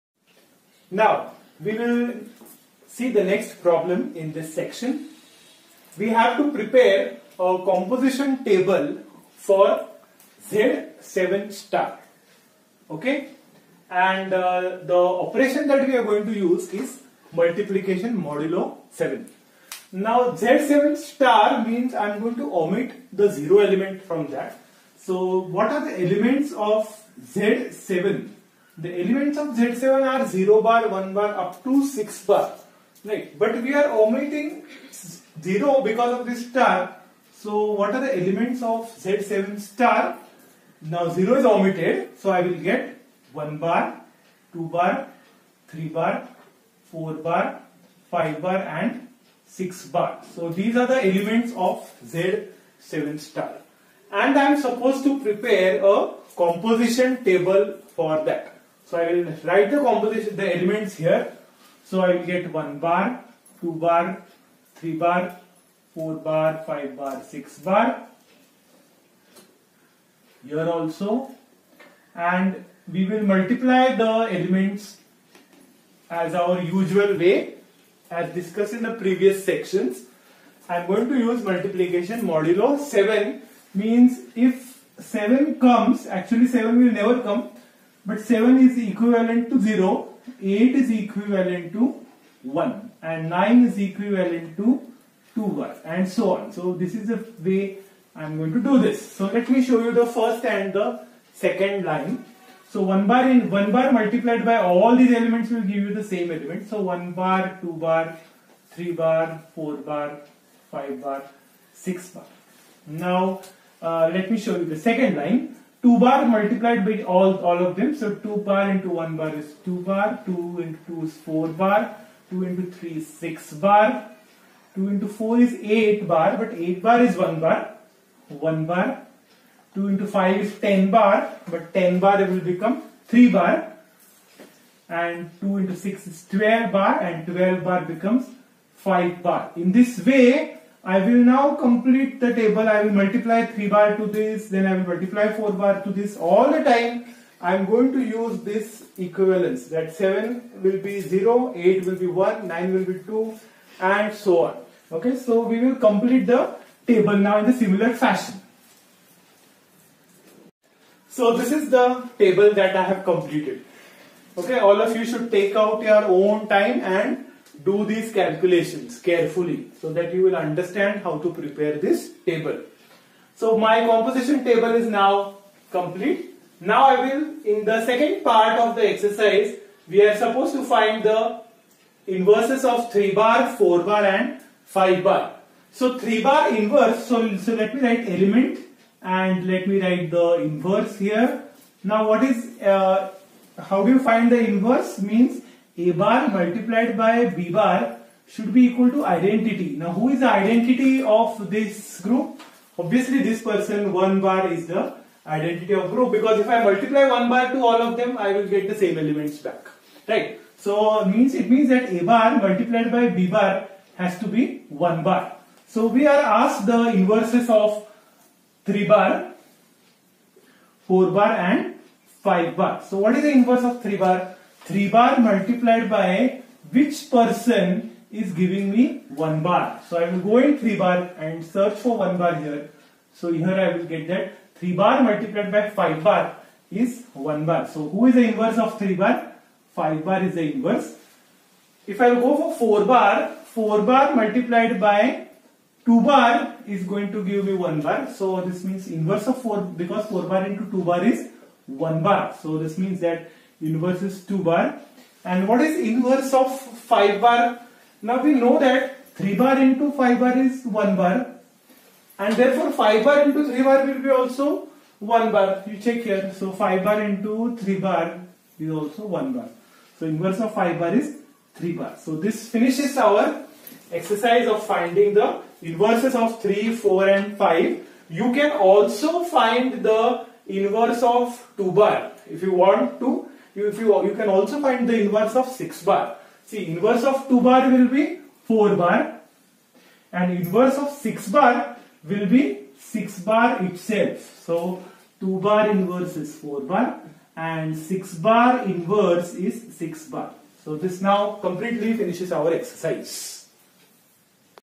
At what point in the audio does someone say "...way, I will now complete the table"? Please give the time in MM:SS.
02:20.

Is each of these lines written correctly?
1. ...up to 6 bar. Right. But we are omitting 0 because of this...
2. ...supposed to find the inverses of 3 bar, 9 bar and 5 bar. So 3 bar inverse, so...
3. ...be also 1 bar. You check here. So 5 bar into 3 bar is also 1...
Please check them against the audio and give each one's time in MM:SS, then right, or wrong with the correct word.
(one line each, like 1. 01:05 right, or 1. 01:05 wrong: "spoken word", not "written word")
1. 00:31 right
2. 03:00 wrong: "4", not "9"
3. 04:24 right.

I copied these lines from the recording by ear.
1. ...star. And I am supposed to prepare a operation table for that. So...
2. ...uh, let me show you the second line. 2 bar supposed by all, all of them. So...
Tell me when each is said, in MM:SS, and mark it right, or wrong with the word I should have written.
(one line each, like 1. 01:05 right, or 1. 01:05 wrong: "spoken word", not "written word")
1. 00:53 wrong: "composition", not "operation"
2. 01:53 wrong: "multiplied", not "supposed".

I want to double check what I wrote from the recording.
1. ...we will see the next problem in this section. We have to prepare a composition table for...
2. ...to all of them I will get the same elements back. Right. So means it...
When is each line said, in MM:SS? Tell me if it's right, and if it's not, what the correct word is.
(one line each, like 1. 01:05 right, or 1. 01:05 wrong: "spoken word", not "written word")
1. 00:01 right
2. 03:27 right.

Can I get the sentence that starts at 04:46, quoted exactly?
See, inverse of 2 bar will be 4 bar and inverse of 6 bar will be 6 bar itself.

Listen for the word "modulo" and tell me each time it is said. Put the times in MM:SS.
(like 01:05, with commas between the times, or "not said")
00:18, 01:22.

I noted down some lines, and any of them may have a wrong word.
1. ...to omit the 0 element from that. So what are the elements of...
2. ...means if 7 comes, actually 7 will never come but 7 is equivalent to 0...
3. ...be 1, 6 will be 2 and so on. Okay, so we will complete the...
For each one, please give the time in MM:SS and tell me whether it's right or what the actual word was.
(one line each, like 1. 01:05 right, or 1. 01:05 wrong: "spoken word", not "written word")
1. 00:22 right
2. 01:23 right
3. 02:31 wrong: "9", not "6".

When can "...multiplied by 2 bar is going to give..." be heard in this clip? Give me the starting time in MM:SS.
04:04.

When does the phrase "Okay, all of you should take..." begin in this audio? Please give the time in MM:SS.
02:44.